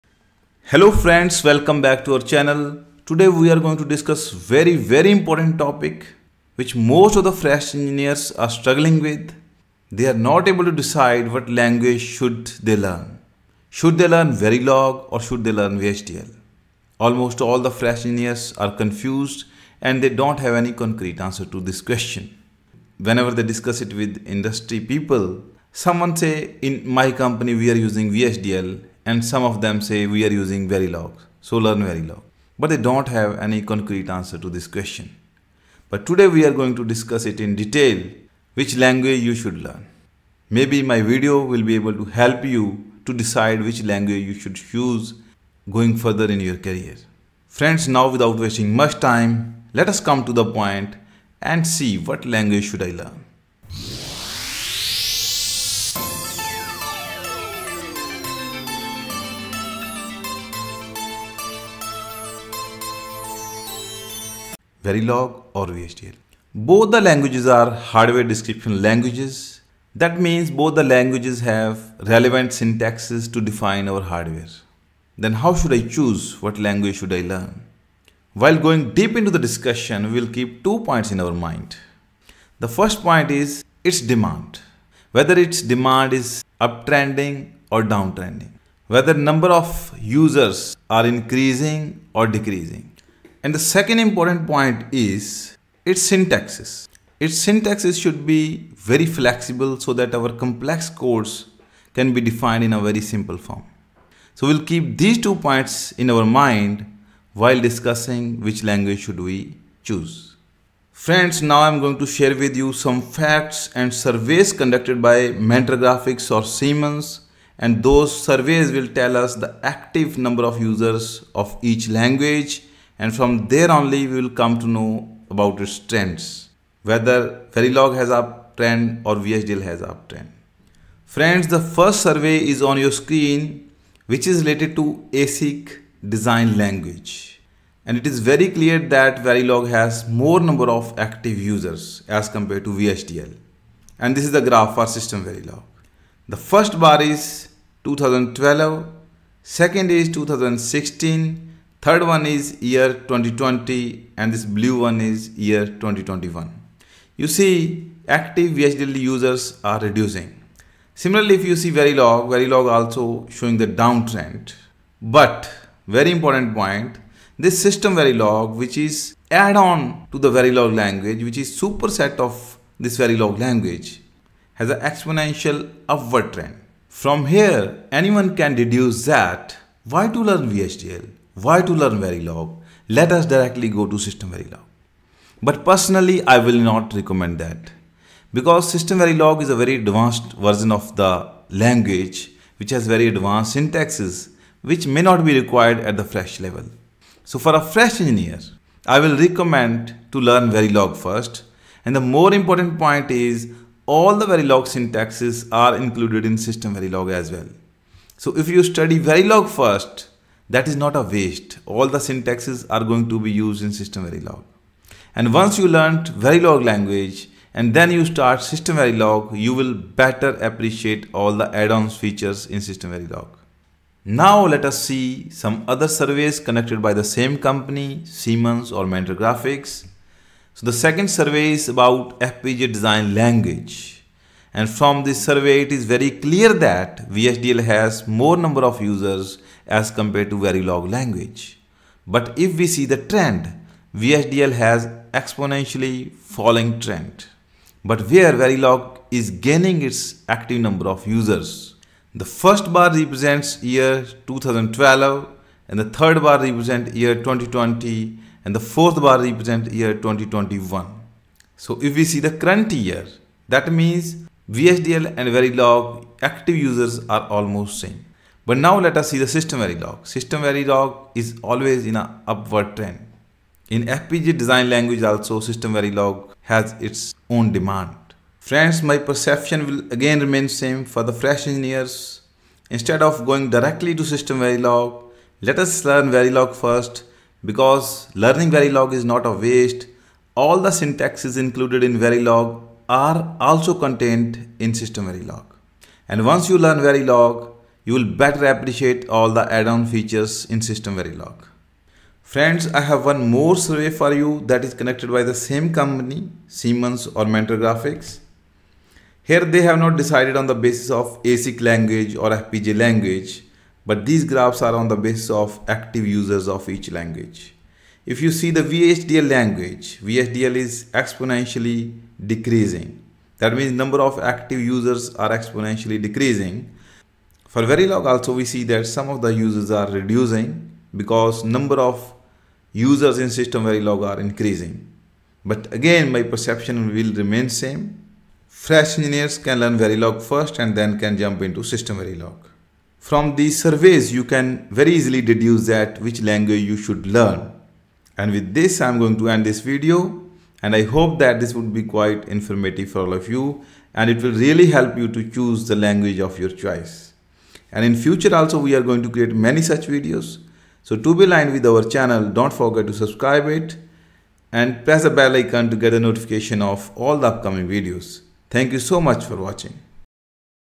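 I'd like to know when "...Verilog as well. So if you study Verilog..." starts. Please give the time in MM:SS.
03:26.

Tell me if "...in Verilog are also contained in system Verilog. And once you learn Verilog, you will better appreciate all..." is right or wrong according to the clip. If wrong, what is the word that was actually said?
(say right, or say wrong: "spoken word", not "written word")
right.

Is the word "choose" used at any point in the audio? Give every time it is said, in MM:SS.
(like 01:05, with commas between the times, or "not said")
00:44, 01:15, 01:49, 05:55.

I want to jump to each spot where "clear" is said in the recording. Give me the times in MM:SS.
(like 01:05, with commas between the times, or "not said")
02:18, 03:56.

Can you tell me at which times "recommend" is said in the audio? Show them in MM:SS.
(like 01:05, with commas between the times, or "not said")
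03:06, 03:19.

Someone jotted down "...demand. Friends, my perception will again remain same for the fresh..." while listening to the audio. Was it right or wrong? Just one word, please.
right.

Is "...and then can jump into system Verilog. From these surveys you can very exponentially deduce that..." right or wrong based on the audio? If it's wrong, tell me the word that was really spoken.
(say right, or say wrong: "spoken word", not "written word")
wrong: "easily", not "exponentially".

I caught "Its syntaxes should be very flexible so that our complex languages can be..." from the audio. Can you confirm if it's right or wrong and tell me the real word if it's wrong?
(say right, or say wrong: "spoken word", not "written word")
wrong: "codes", not "languages".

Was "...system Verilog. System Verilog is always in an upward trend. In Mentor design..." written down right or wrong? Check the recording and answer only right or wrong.
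wrong.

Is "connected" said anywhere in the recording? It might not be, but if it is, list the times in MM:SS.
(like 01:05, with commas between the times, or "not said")
03:46, 05:04.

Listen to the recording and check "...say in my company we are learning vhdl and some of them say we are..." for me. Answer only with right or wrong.
wrong.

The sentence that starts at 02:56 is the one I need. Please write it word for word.
From here, anyone can deduce that why to learn VHDL?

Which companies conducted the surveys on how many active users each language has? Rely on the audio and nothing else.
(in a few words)
Mentor Graphics or Siemens.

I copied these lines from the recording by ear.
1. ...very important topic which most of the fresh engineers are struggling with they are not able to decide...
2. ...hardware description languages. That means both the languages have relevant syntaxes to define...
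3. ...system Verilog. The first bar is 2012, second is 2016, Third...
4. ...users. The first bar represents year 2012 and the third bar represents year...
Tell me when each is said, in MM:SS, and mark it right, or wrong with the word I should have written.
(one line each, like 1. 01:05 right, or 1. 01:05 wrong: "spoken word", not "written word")
1. 00:04 right
2. 01:07 right
3. 02:24 right
4. 04:11 right.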